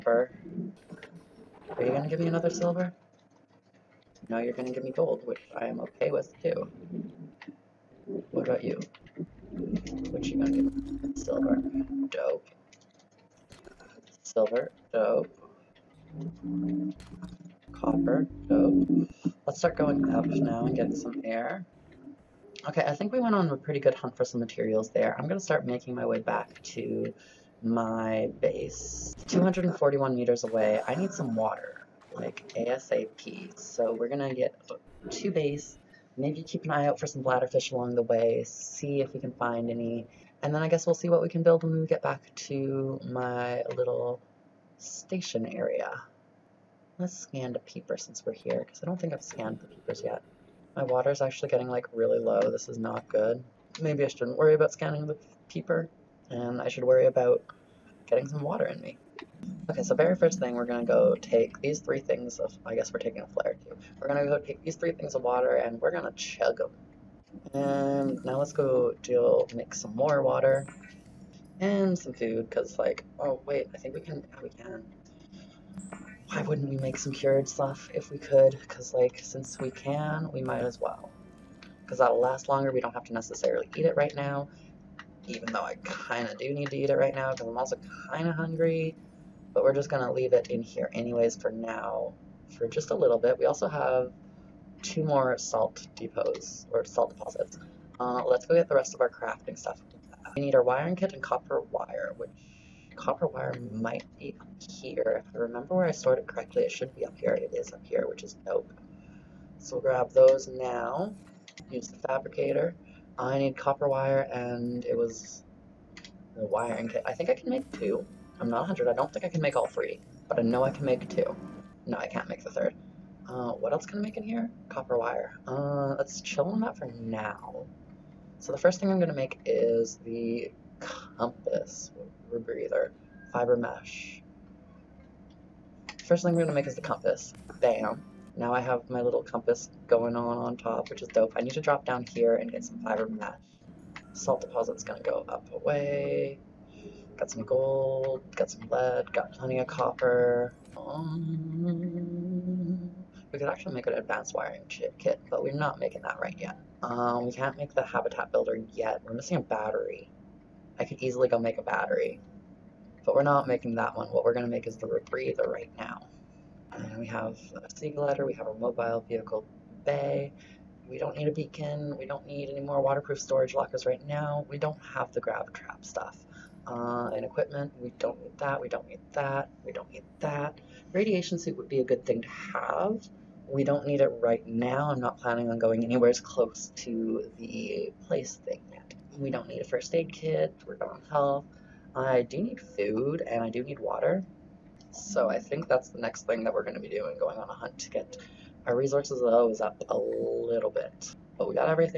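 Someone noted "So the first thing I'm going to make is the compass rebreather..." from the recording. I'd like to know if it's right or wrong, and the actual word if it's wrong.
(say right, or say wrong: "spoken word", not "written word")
right.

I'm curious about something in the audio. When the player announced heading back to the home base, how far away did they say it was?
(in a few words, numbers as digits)
241 meters.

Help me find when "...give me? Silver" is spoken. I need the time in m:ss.
0:10.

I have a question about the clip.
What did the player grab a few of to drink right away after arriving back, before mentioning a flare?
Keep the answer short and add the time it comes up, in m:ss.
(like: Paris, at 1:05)
three things of water, at 1:04.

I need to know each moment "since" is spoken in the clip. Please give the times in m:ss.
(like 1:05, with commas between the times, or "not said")
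0:47, 1:19.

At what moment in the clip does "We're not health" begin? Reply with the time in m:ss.
3:10.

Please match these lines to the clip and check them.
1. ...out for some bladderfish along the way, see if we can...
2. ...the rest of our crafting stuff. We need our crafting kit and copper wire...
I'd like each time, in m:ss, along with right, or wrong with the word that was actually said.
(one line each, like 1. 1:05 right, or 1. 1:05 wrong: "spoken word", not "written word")
1. 0:36 right
2. 1:38 wrong: "wiring", not "crafting".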